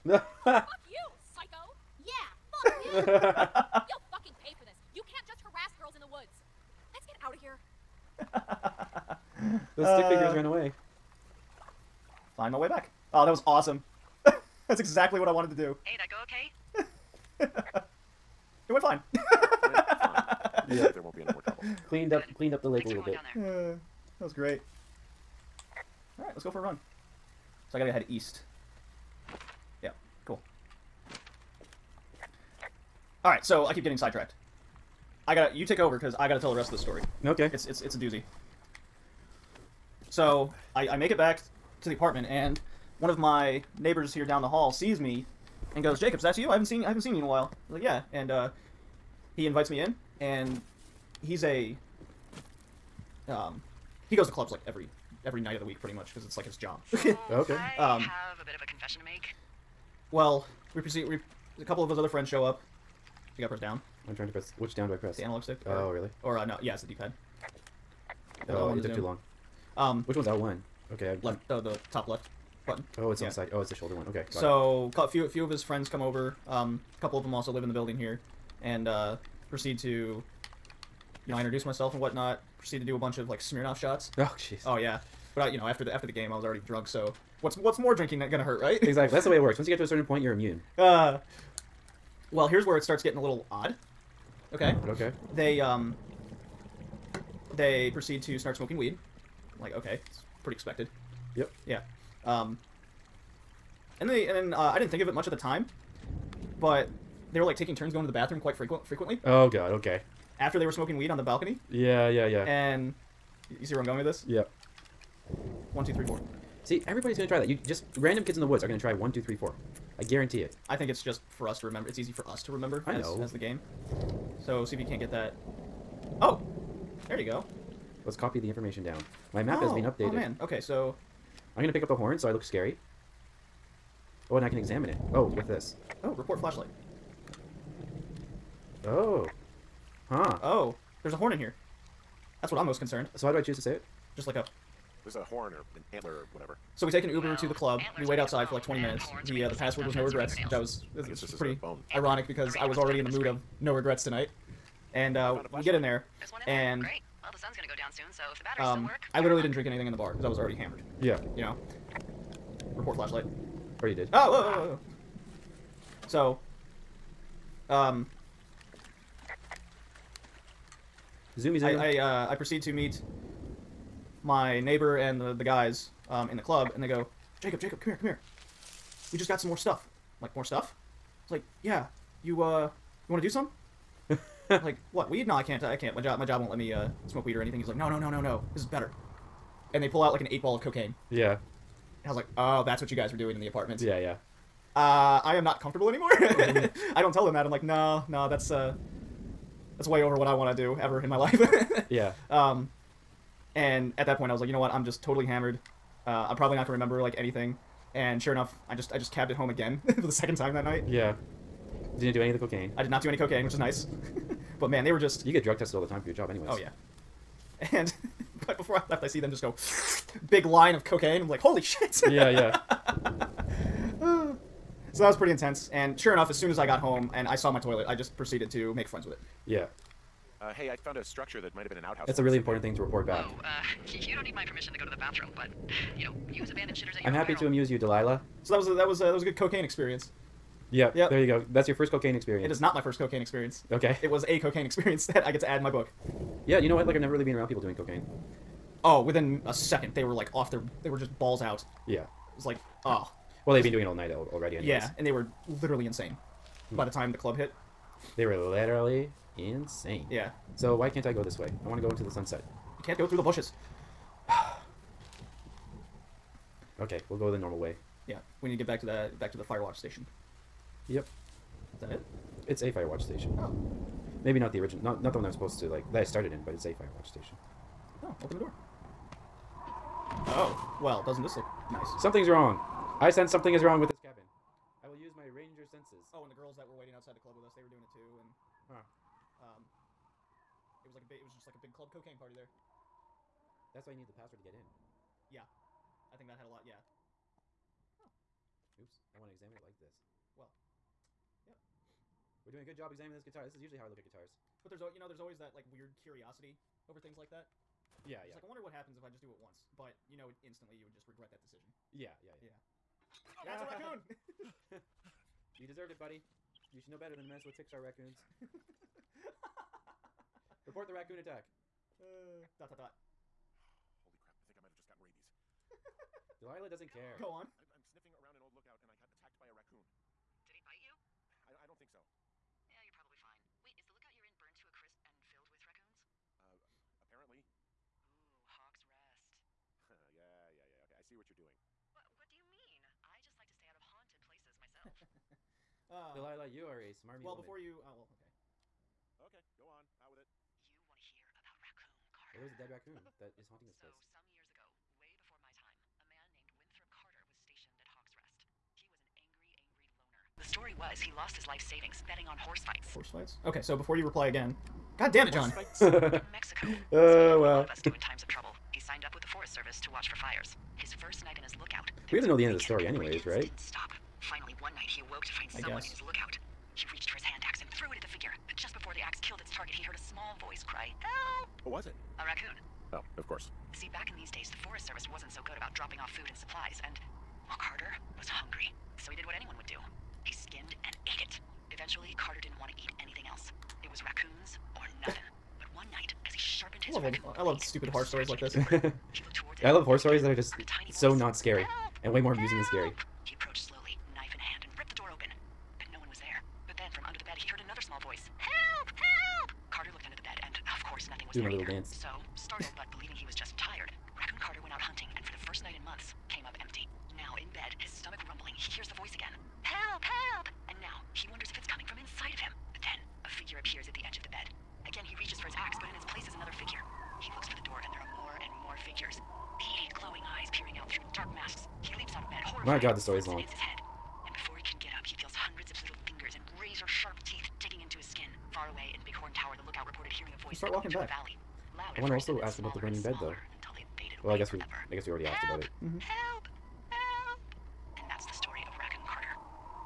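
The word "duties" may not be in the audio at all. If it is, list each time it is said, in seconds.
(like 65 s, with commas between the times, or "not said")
not said.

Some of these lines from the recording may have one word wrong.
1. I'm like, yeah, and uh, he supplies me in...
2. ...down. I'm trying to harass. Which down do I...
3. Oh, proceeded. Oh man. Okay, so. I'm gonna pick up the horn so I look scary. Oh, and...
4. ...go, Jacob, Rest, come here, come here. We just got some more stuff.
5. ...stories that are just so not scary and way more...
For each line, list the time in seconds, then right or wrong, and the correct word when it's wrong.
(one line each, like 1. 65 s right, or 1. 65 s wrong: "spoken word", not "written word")
1. 47 s wrong: "invites", not "supplies"
2. 63 s wrong: "press", not "harass"
3. 129 s wrong: "updated", not "proceeded"
4. 176 s wrong: "Jacob", not "Rest"
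5. 399 s right.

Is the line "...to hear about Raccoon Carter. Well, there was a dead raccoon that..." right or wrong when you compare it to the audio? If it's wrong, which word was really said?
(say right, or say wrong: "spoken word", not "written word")
right.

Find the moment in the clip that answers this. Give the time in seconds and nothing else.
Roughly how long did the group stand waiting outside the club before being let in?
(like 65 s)
148 s.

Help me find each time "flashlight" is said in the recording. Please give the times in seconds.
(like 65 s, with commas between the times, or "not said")
136 s, 162 s.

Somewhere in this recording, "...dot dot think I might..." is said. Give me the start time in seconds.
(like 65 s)
322 s.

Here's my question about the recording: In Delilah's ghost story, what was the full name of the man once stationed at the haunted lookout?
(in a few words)
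Winthrop Carter.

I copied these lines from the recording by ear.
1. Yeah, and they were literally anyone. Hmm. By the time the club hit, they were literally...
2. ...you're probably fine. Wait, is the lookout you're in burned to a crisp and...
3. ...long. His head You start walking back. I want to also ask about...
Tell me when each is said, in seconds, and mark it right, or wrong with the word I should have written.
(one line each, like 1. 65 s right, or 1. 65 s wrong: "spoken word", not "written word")
1. 254 s wrong: "insane", not "anyone"
2. 332 s right
3. 433 s right.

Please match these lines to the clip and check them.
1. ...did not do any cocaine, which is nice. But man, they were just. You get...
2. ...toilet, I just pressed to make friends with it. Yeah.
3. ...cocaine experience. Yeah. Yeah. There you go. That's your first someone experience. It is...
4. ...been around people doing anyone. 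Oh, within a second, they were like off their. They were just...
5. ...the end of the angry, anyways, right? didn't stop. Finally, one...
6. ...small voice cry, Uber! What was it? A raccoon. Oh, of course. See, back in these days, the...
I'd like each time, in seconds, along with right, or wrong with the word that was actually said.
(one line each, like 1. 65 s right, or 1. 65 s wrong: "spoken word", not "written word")
1. 212 s right
2. 227 s wrong: "proceeded", not "pressed"
3. 239 s wrong: "cocaine", not "someone"
4. 247 s wrong: "cocaine", not "anyone"
5. 372 s wrong: "story", not "angry"
6. 379 s wrong: "Help", not "Uber".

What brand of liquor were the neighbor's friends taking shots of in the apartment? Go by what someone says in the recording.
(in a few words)
Smirnoff.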